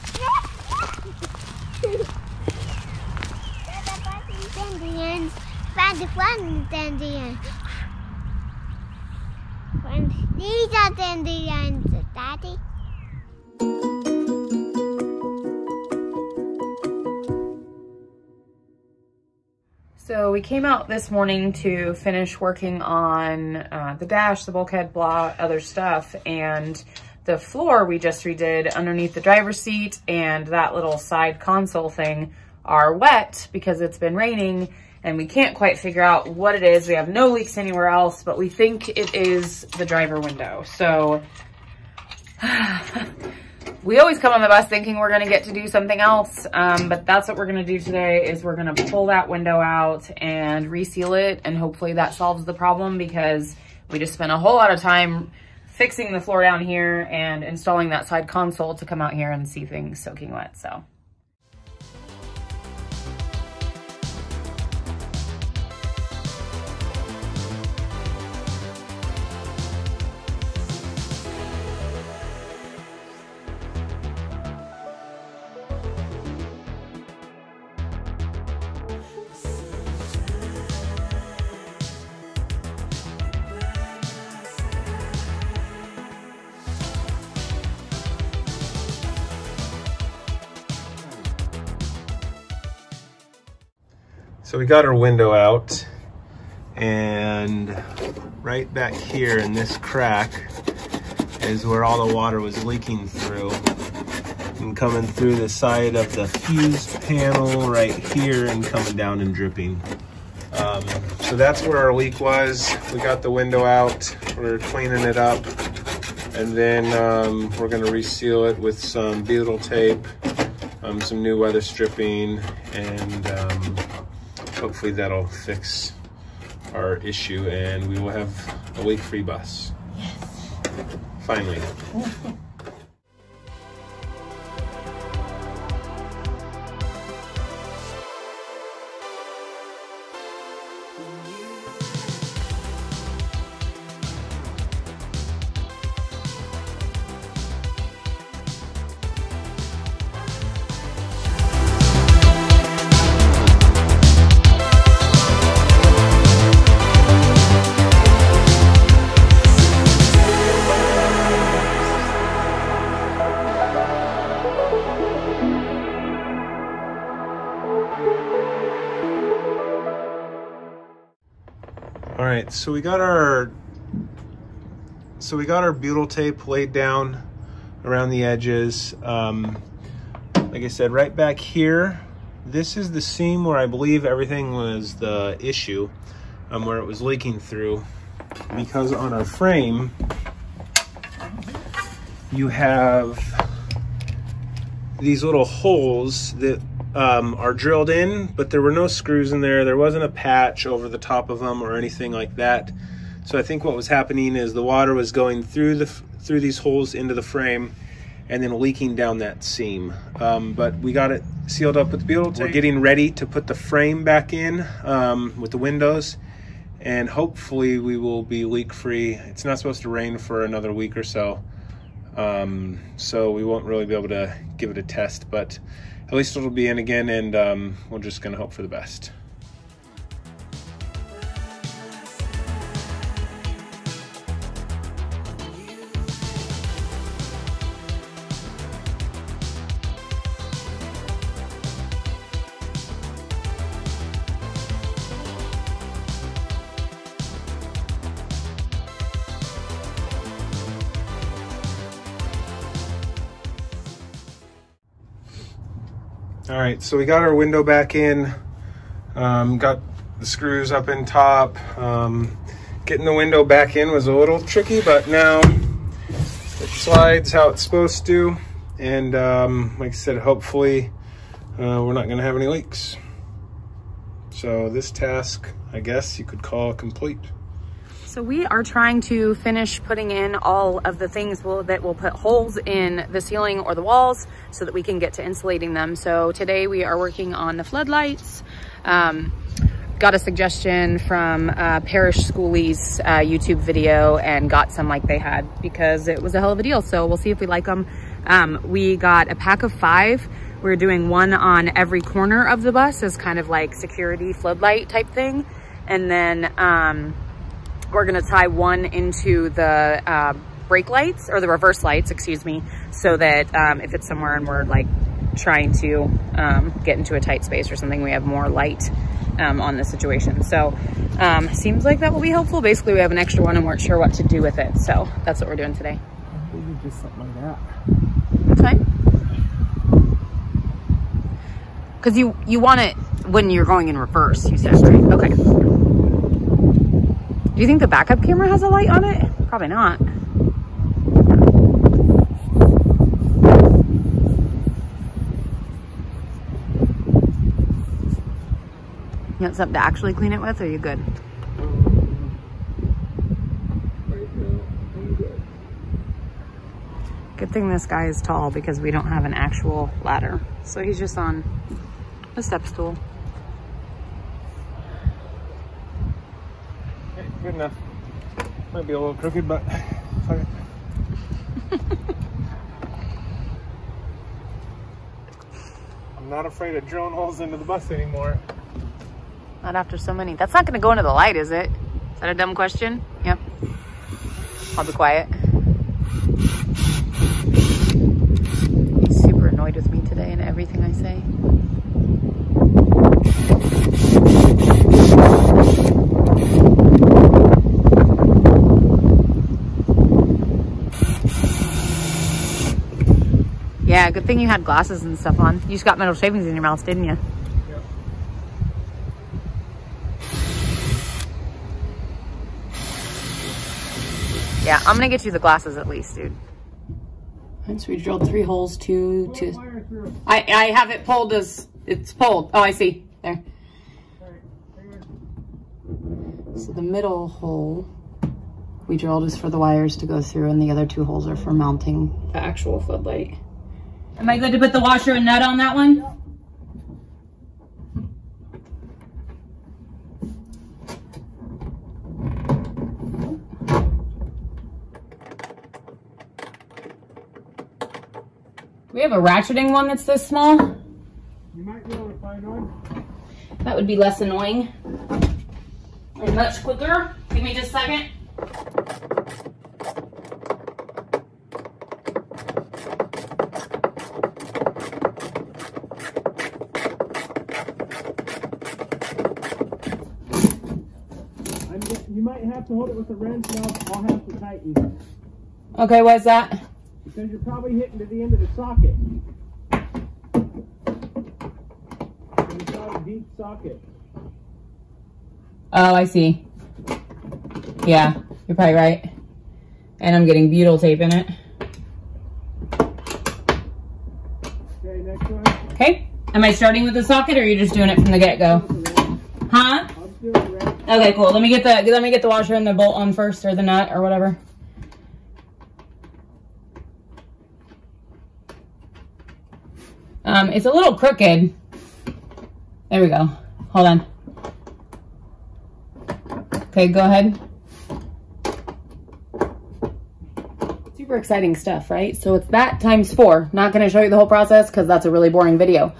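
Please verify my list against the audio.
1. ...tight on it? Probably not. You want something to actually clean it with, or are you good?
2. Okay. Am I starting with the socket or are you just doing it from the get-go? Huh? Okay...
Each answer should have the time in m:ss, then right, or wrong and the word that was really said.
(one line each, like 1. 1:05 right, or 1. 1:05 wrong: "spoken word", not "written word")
1. 5:38 wrong: "light", not "tight"
2. 8:15 right.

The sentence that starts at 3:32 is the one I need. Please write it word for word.
We're getting ready to put the frame back in um, with the windows and hopefully we will be leak free.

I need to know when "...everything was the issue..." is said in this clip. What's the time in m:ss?
3:04.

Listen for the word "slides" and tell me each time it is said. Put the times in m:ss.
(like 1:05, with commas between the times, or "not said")
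4:26.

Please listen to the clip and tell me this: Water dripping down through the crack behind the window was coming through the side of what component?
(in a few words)
fuse panel.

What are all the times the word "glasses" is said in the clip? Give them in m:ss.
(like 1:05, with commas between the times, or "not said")
6:44, 6:55.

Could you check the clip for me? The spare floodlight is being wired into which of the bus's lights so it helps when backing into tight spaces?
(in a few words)
reverse lights.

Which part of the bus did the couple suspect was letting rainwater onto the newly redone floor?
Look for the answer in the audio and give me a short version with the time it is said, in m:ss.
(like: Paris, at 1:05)
driver window, at 0:39.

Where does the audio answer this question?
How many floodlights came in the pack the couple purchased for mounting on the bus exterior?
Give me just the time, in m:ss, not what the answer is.
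4:59.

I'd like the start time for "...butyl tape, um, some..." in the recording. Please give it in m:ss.
1:59.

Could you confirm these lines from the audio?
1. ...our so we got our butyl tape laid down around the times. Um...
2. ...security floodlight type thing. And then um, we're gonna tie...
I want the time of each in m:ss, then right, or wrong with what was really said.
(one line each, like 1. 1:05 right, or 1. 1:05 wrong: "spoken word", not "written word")
1. 2:53 wrong: "edges", not "times"
2. 5:03 right.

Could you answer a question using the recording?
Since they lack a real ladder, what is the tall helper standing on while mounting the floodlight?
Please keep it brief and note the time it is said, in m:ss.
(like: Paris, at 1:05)
step stool, at 6:02.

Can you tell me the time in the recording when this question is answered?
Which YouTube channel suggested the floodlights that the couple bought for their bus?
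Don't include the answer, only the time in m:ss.
4:51.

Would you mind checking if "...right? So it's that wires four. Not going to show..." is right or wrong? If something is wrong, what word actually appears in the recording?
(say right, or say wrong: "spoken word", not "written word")
wrong: "times", not "wires".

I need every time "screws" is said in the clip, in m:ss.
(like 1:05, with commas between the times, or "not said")
3:18, 4:20.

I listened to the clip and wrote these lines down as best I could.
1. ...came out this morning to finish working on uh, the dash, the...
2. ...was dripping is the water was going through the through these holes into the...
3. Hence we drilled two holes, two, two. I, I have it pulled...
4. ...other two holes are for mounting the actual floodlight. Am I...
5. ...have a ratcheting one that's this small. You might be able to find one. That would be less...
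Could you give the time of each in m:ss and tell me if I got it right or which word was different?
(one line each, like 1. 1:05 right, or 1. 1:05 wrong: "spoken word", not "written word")
1. 0:20 right
2. 3:23 wrong: "happening", not "dripping"
3. 6:57 wrong: "three", not "two"
4. 7:10 right
5. 7:29 right.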